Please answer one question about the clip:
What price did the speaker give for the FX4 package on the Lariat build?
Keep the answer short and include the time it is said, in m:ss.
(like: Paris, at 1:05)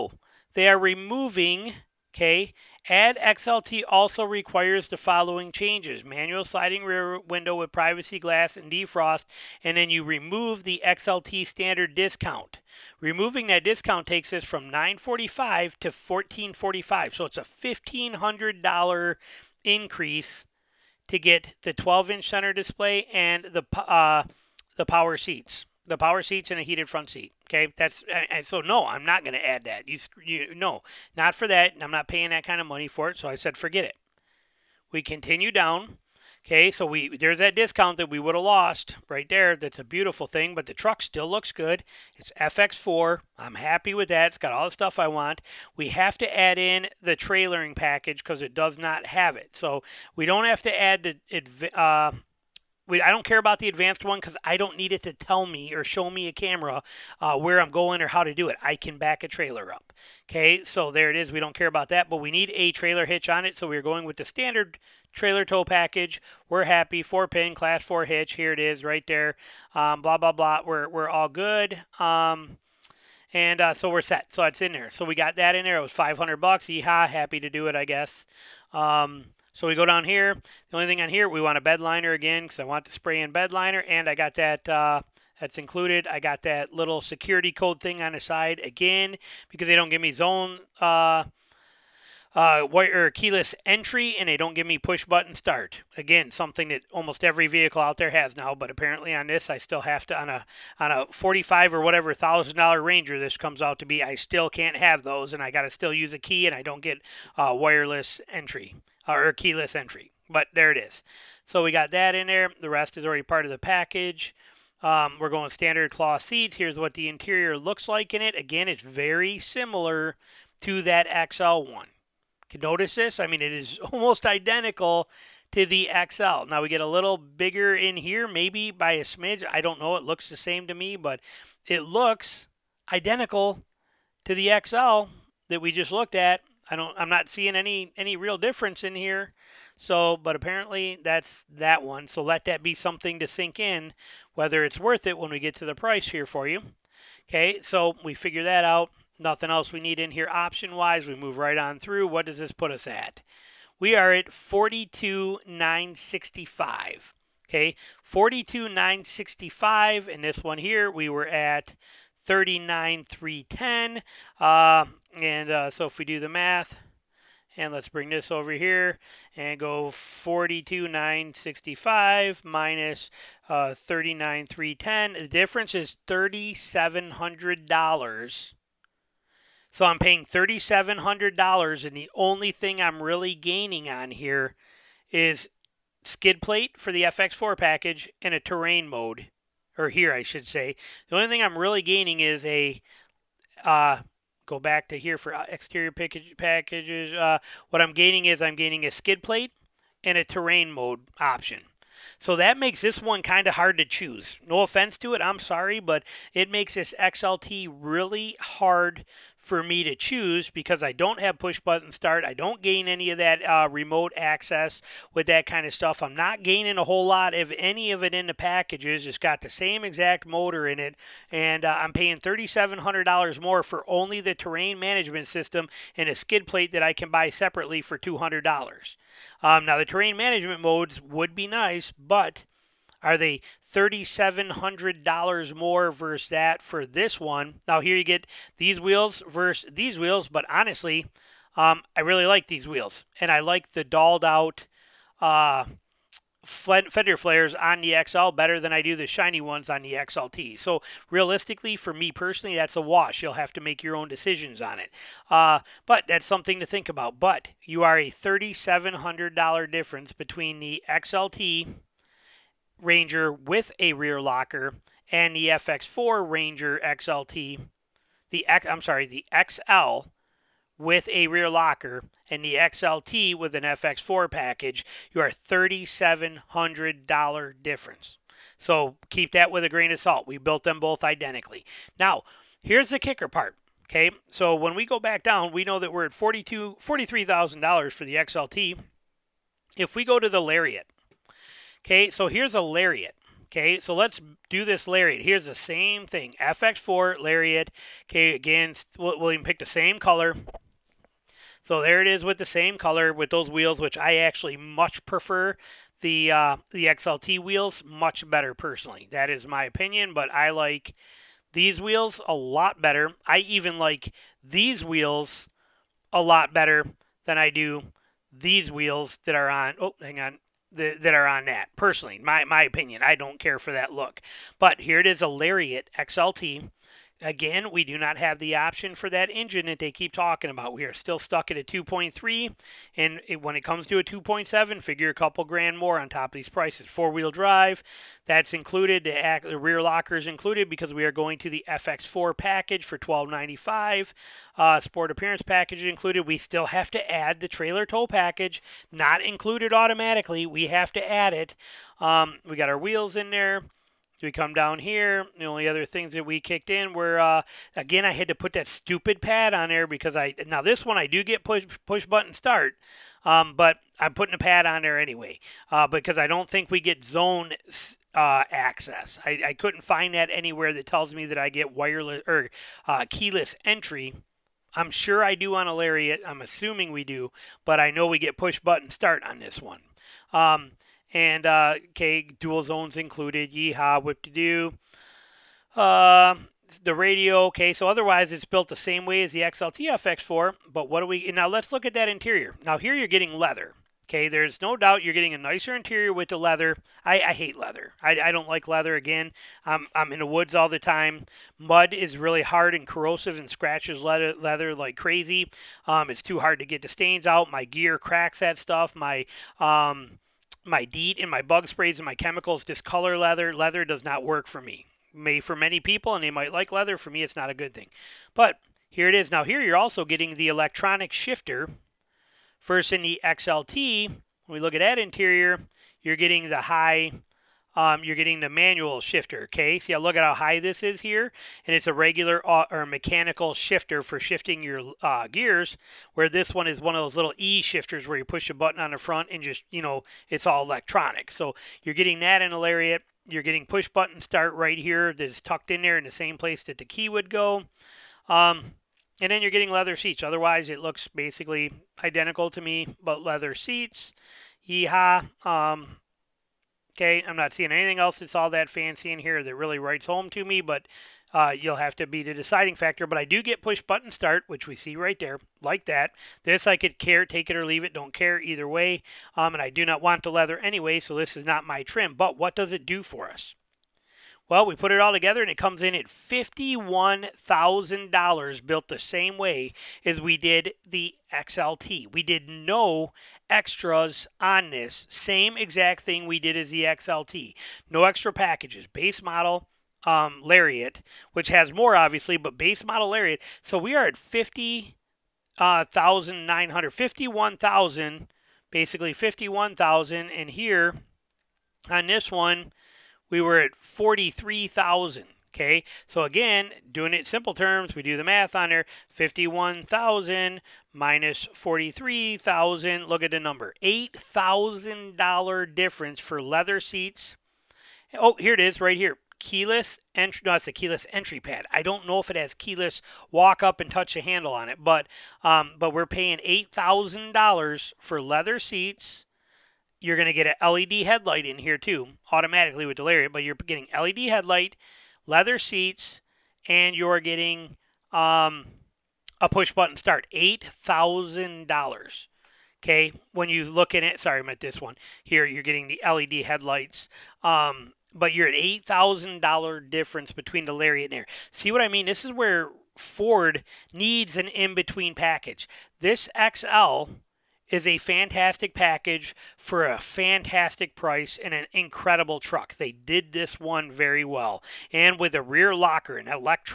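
$1,295, at 5:42.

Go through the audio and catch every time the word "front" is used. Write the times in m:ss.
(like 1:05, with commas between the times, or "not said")
0:26, 7:18.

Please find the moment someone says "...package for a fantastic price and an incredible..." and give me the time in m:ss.
9:18.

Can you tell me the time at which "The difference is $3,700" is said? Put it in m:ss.
2:55.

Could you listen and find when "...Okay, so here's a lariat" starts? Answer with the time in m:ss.
4:51.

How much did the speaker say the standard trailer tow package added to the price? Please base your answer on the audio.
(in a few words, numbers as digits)
$500.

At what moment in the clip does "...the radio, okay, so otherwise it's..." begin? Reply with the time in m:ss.
6:26.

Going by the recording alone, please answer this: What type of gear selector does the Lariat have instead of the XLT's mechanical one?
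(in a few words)
Electronic shifter.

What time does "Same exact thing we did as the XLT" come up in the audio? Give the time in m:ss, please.
8:05.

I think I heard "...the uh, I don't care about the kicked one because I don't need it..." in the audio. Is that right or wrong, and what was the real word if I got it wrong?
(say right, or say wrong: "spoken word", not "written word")
wrong: "advanced", not "kicked".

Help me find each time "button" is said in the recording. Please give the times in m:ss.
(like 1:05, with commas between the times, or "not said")
1:35, 3:31, 6:02, 6:18, 7:18, 7:23, 7:43, 8:59.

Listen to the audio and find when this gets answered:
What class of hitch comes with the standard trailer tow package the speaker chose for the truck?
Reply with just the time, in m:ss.
1:07.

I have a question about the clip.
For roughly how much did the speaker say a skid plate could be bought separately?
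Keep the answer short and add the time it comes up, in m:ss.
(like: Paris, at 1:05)
$200, at 3:47.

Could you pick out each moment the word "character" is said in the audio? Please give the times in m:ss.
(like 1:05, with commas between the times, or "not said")
not said.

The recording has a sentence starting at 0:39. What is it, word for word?
That's a beautiful thing, but the truck still looks good.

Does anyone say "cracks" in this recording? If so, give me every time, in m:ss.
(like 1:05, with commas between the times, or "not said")
6:47.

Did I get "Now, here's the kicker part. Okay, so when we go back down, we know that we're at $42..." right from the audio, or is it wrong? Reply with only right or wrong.
right.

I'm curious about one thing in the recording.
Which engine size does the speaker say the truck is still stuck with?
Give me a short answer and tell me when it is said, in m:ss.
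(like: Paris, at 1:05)
2.3, at 5:31.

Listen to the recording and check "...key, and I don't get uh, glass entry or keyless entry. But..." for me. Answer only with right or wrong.
wrong.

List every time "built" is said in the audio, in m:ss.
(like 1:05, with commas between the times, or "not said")
4:40, 6:28, 7:58.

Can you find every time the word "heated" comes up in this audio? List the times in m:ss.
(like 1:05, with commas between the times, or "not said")
0:26.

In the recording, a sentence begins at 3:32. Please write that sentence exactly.
I don't gain any of that uh, remote access with that kind of stuff.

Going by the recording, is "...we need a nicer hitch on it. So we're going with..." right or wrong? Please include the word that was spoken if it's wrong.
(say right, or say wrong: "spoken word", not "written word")
wrong: "trailer", not "nicer".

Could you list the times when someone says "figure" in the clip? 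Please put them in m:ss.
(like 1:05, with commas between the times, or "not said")
2:28, 5:34.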